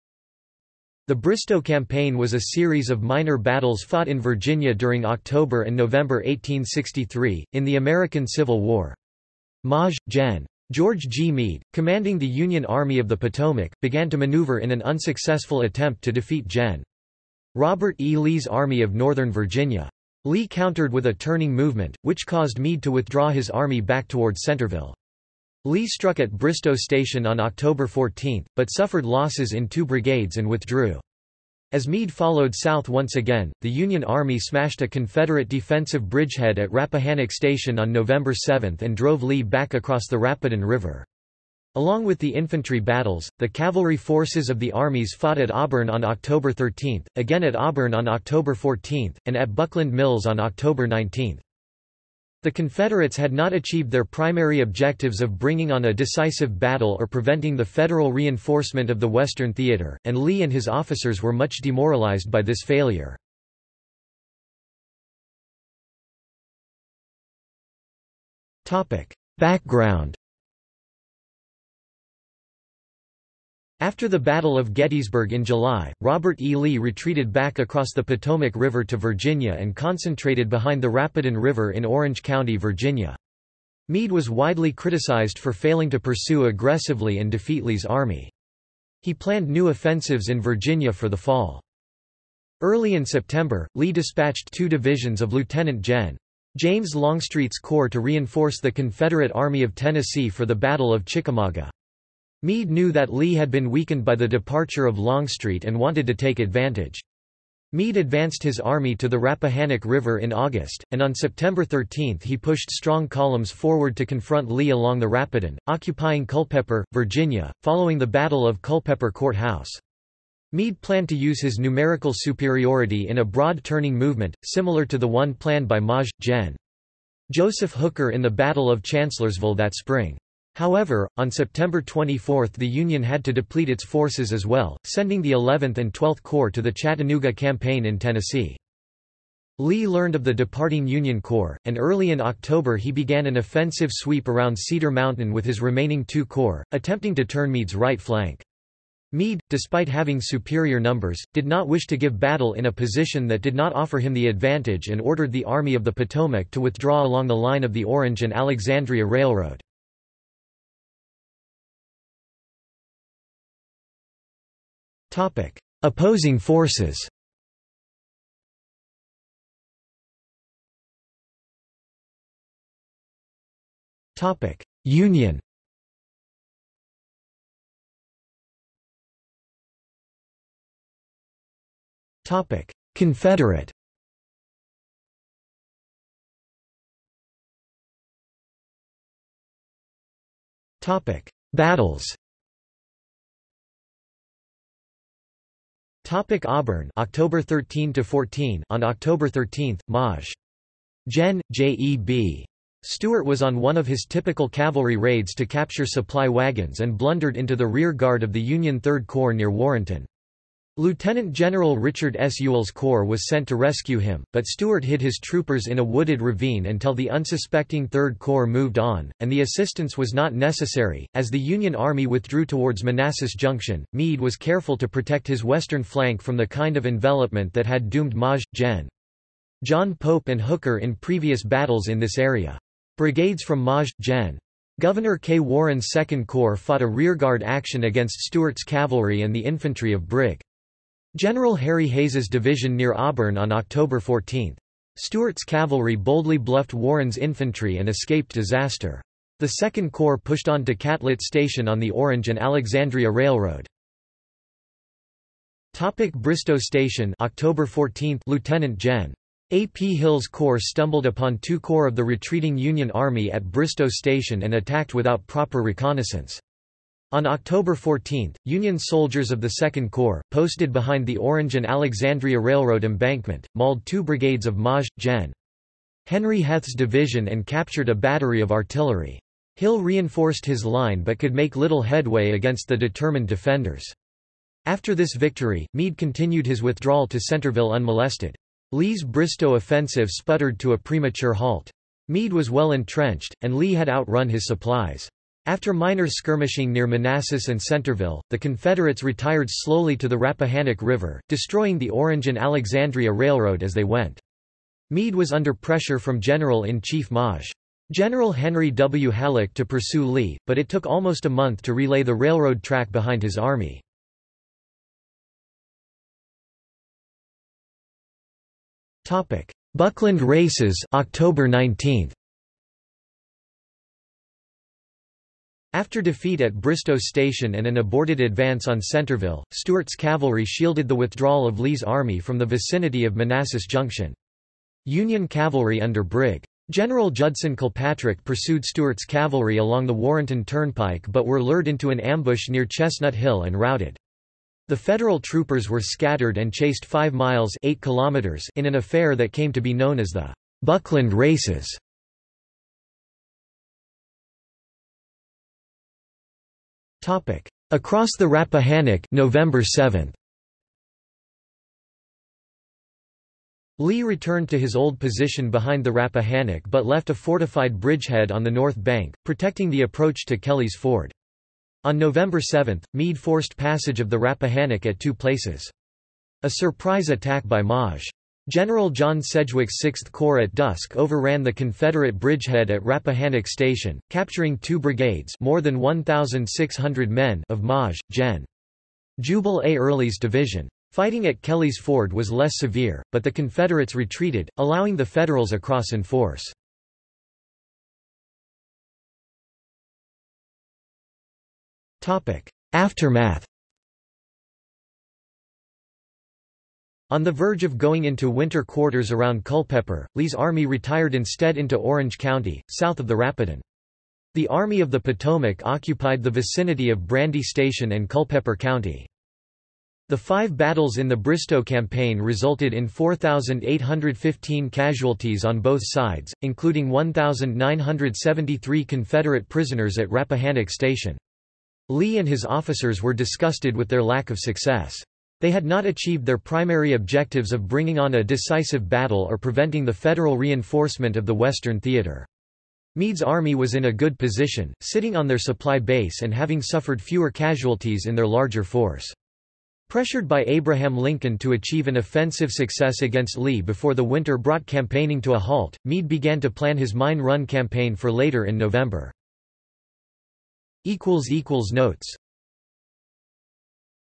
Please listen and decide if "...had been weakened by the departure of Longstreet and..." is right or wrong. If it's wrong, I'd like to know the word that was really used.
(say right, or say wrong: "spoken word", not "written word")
right.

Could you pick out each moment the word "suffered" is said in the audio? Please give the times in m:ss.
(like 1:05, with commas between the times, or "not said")
0:28, 7:26.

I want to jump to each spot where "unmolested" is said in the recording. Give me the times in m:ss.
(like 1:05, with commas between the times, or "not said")
4:47.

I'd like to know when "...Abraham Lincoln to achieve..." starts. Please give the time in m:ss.
7:30.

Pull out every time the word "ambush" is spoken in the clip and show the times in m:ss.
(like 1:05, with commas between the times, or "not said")
5:41.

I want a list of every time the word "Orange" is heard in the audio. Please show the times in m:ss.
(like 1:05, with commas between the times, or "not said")
1:21, 2:37, 4:11, 4:31, 5:01, 6:51.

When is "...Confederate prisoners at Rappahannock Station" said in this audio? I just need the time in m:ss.
7:08.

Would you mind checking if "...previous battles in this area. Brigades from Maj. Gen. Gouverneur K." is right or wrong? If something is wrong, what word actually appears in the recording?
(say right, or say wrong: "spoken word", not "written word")
right.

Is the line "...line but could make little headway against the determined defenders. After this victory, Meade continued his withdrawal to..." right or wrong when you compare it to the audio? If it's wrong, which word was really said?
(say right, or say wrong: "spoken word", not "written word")
right.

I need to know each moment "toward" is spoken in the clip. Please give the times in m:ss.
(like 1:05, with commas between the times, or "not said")
0:24, 3:42.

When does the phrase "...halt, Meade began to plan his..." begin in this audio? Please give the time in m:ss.
7:35.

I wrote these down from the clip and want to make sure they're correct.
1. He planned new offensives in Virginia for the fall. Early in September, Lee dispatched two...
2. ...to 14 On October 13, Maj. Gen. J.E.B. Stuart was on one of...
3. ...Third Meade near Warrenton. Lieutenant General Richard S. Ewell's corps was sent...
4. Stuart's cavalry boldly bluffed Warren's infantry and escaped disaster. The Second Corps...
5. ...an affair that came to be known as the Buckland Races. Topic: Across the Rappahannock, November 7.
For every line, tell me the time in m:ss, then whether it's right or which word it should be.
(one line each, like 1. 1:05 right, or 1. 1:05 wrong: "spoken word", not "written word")
1. 1:29 right
2. 3:17 right
3. 3:28 wrong: "Corps", not "Meade"
4. 4:04 right
5. 5:48 right.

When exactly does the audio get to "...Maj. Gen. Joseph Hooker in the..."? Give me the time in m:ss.
2:05.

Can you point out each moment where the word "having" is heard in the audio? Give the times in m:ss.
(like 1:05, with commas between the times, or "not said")
2:29, 7:26.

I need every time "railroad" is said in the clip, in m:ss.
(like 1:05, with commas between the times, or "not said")
2:39, 4:13, 4:32, 5:03, 5:12.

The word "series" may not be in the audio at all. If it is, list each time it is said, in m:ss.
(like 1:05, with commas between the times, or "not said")
0:02.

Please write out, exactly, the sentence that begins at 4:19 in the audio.
Hill's corps stumbled upon two corps of the retreating Union Army at Bristoe Station and attacked without proper reconnaissance.